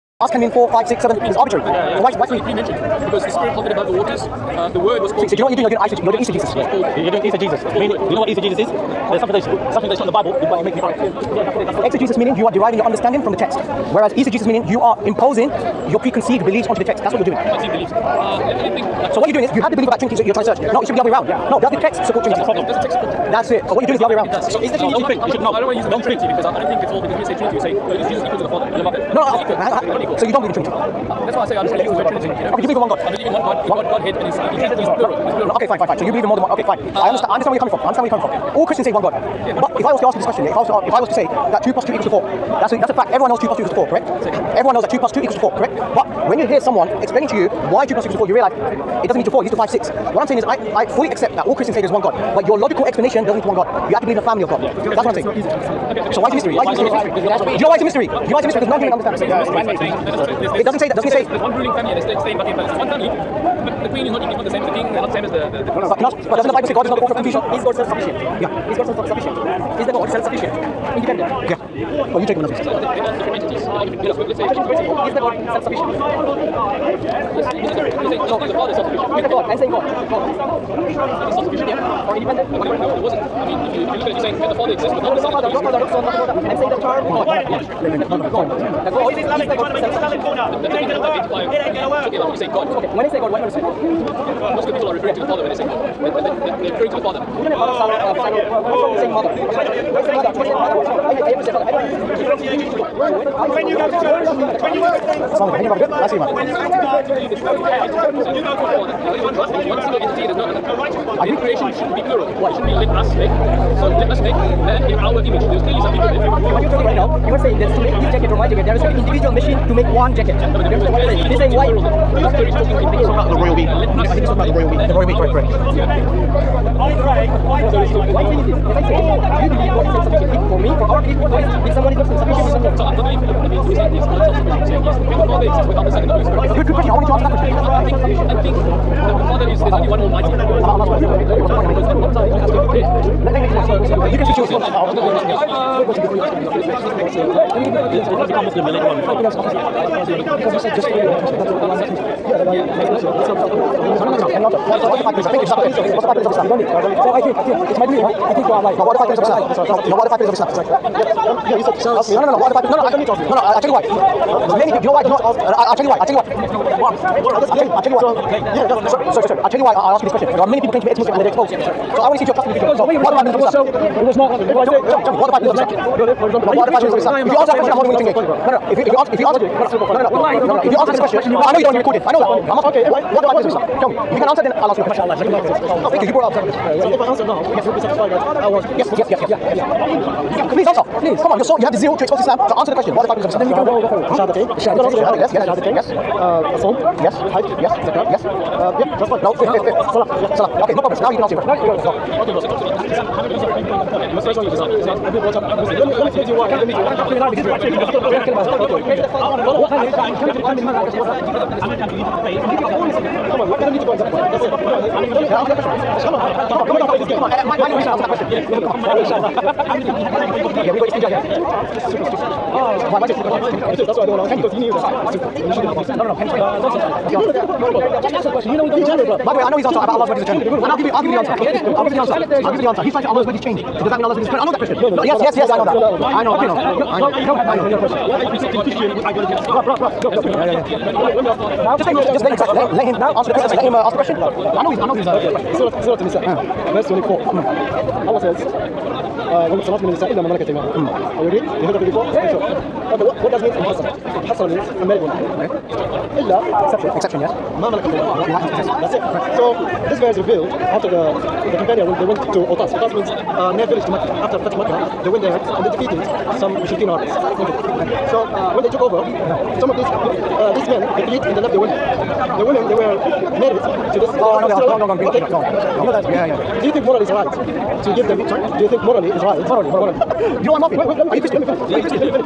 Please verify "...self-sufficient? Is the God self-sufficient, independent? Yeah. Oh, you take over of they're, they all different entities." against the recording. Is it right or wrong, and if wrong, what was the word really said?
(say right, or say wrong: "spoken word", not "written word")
right.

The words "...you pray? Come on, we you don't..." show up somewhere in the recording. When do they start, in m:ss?
3:31.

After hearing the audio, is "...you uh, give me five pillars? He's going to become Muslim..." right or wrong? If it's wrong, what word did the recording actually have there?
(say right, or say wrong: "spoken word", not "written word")
right.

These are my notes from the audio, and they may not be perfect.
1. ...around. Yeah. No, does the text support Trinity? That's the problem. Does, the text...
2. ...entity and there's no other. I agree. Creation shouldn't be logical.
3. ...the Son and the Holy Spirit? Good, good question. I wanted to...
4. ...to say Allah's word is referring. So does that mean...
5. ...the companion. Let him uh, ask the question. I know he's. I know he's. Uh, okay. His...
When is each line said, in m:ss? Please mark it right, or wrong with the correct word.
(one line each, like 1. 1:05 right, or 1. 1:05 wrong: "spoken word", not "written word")
1. 0:21 right
2. 1:49 wrong: "plural", not "logical"
3. 2:15 right
4. 3:53 wrong: "changing", not "referring"
5. 4:03 wrong: "question", not "companion".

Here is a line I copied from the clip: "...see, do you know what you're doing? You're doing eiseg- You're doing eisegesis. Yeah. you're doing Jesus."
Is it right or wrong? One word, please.
right.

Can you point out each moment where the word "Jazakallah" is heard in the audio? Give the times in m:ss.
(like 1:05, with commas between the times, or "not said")
2:35, 3:05.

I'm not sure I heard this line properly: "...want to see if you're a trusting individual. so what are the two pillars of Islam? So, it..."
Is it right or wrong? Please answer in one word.
wrong.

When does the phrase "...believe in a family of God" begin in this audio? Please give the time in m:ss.
0:54.